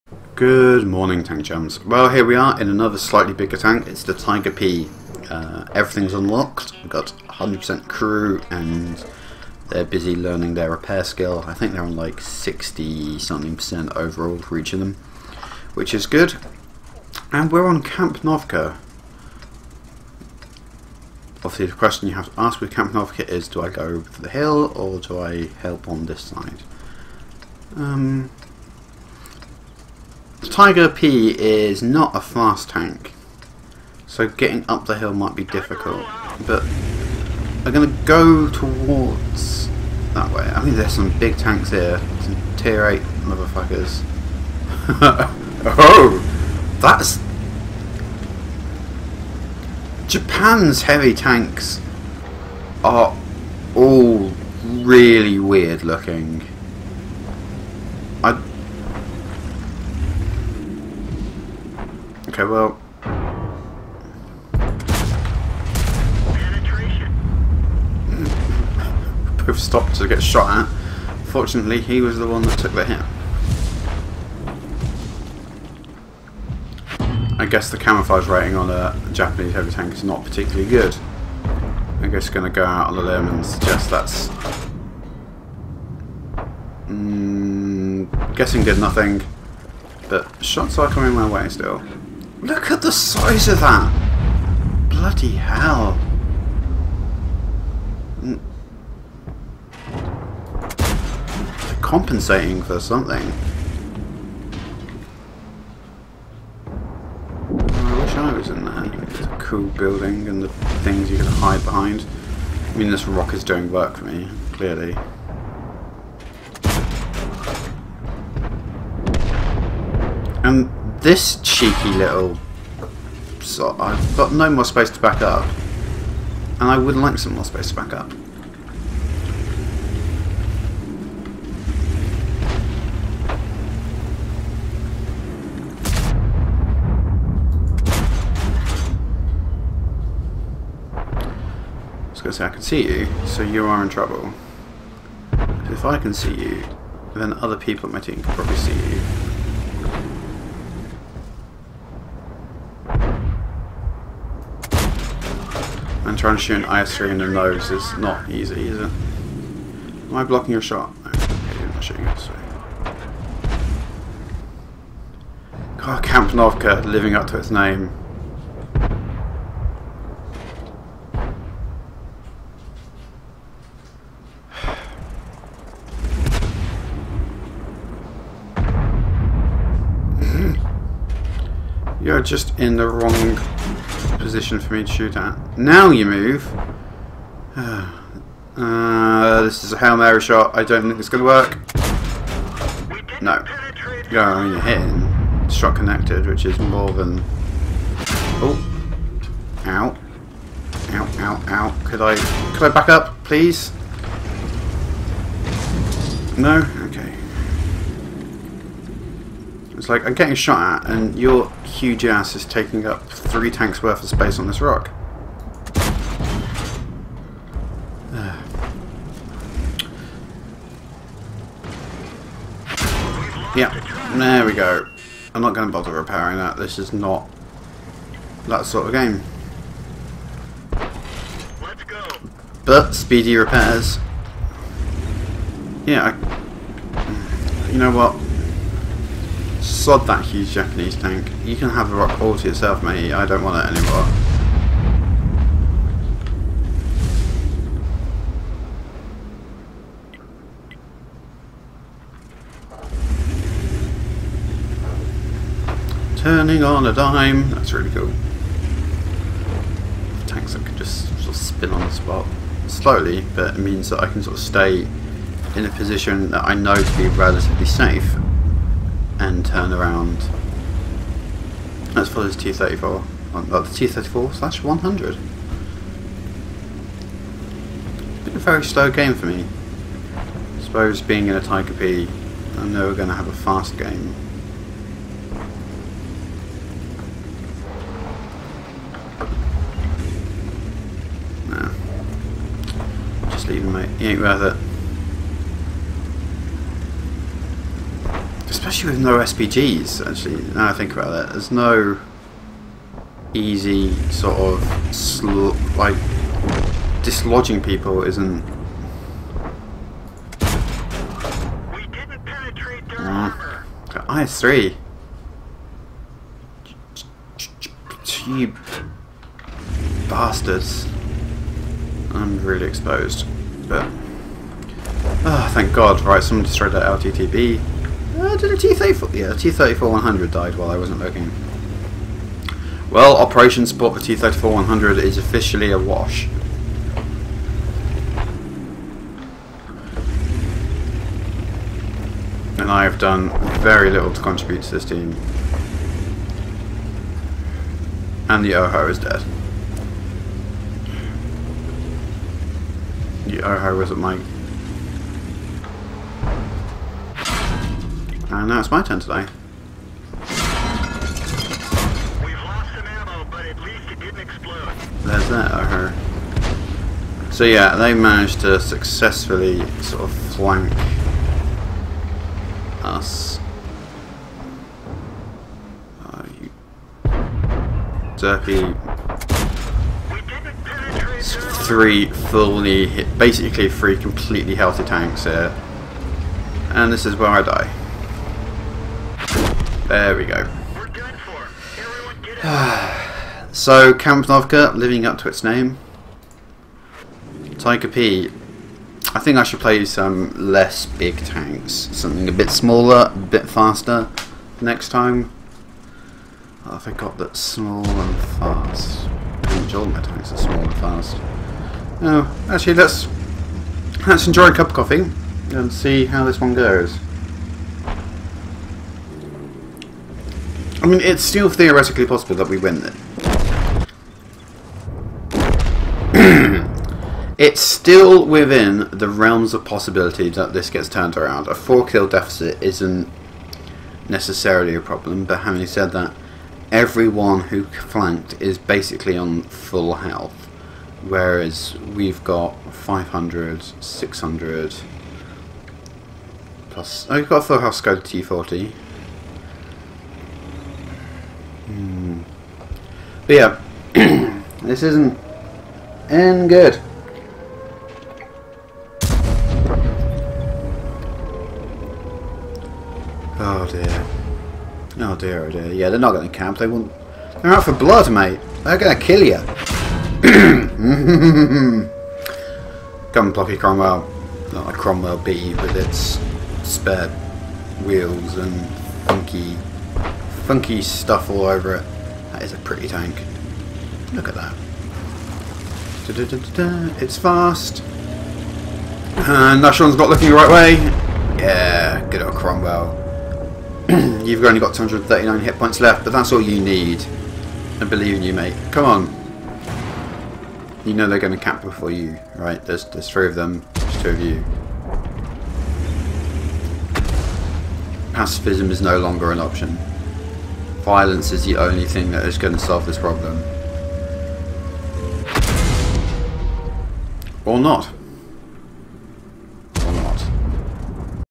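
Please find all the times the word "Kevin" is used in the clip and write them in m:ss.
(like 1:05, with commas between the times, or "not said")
not said.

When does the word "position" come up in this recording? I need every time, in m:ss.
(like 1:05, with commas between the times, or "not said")
3:04, 4:25.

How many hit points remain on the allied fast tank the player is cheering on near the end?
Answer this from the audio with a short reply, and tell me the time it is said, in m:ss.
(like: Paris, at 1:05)
239, at 8:14.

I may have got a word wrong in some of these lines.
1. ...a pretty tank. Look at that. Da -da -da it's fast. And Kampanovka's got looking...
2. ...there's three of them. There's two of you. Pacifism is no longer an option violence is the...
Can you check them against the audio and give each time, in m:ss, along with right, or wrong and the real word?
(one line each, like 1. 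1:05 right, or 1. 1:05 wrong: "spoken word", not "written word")
1. 8:02 wrong: "Nashon", not "Kampanovka"
2. 8:22 right.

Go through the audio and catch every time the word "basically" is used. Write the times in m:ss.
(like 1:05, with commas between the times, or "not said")
6:23, 7:18.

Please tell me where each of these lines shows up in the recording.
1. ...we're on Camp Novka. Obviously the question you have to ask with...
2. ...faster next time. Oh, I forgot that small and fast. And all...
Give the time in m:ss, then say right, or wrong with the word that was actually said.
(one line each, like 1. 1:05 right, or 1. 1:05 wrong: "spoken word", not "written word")
1. 0:17 right
2. 6:43 right.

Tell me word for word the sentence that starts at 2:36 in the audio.
And trying to shoot an IS-3 in the nose is not easy, is it?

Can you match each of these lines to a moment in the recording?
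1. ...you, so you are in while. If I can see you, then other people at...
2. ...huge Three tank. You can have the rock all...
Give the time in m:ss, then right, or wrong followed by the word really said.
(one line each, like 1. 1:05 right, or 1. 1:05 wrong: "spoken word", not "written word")
1. 2:22 wrong: "trouble", not "while"
2. 4:00 wrong: "Japanese", not "Three".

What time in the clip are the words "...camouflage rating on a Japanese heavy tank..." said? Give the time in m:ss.
1:17.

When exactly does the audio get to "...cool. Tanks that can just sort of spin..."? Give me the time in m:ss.
4:17.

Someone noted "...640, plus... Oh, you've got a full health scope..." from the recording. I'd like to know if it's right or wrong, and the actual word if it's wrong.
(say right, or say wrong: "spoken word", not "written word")
wrong: "600", not "640".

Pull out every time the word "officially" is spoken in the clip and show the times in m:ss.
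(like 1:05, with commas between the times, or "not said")
5:35.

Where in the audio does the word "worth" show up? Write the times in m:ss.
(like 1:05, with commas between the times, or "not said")
3:33, 4:54.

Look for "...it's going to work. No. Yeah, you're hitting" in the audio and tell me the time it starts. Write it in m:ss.
3:10.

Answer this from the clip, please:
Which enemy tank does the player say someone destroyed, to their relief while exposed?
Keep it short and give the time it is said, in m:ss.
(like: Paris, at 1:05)
LTTB, at 5:26.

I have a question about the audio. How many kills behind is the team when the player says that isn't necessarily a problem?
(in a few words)
4.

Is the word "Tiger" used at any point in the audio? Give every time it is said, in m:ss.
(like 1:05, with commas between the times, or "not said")
0:04, 0:30, 4:41, 6:37.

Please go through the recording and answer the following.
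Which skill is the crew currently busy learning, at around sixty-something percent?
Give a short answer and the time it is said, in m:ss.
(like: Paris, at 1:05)
repair, at 0:10.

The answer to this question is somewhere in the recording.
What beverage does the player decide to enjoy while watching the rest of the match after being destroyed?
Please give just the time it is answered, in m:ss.
6:54.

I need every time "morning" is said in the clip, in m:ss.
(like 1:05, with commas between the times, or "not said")
0:00.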